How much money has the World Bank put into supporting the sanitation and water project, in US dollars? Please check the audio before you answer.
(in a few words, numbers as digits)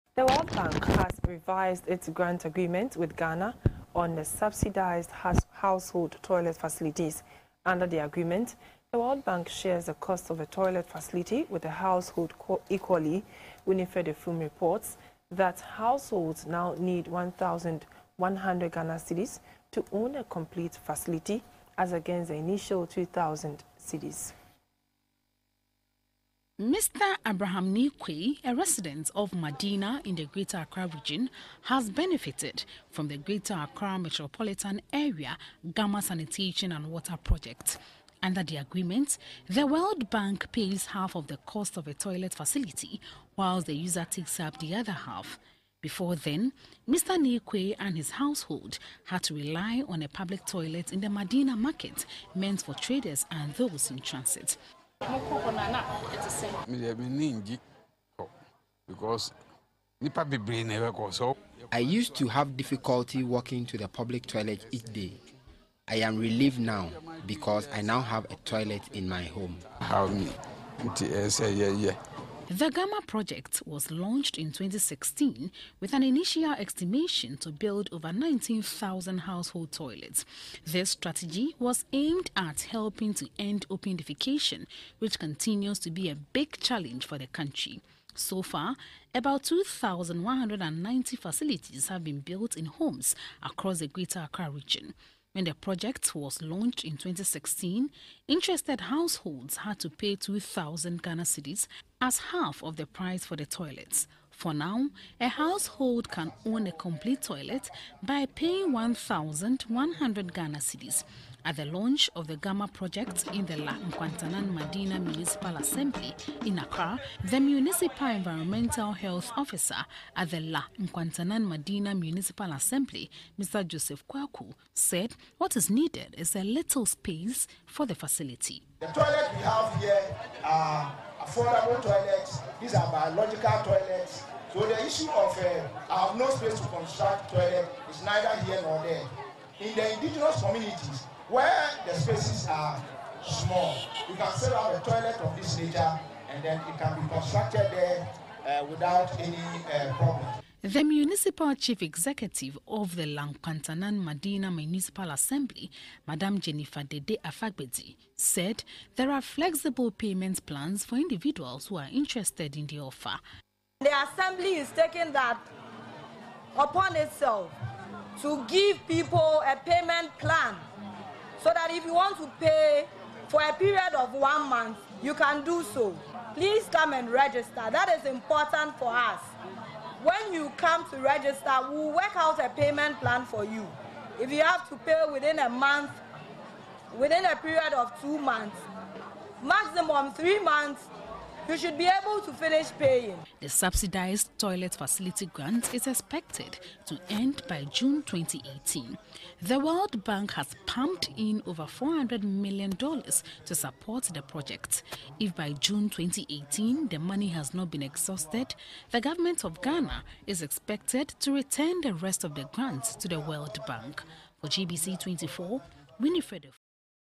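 $400 million.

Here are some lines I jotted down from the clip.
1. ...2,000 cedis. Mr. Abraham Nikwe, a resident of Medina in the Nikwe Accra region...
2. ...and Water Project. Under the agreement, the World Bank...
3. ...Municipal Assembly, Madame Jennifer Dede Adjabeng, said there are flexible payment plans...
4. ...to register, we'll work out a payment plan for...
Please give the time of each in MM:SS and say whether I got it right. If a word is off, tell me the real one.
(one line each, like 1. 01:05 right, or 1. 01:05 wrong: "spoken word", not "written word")
1. 00:22 wrong: "Greater", not "Nikwe"
2. 00:36 right
3. 02:34 right
4. 03:00 right.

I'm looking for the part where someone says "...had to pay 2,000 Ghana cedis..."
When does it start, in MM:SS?
01:39.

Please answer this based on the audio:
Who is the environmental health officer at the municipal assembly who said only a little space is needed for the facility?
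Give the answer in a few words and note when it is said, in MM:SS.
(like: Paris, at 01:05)
Joseph Kwaku, at 02:03.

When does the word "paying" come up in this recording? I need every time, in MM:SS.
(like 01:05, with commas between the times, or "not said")
01:48, 03:12.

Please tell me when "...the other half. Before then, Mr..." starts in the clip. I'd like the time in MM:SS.
00:44.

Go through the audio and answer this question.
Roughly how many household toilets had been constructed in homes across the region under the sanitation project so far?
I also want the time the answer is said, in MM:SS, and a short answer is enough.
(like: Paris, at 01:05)
2,190, at 01:29.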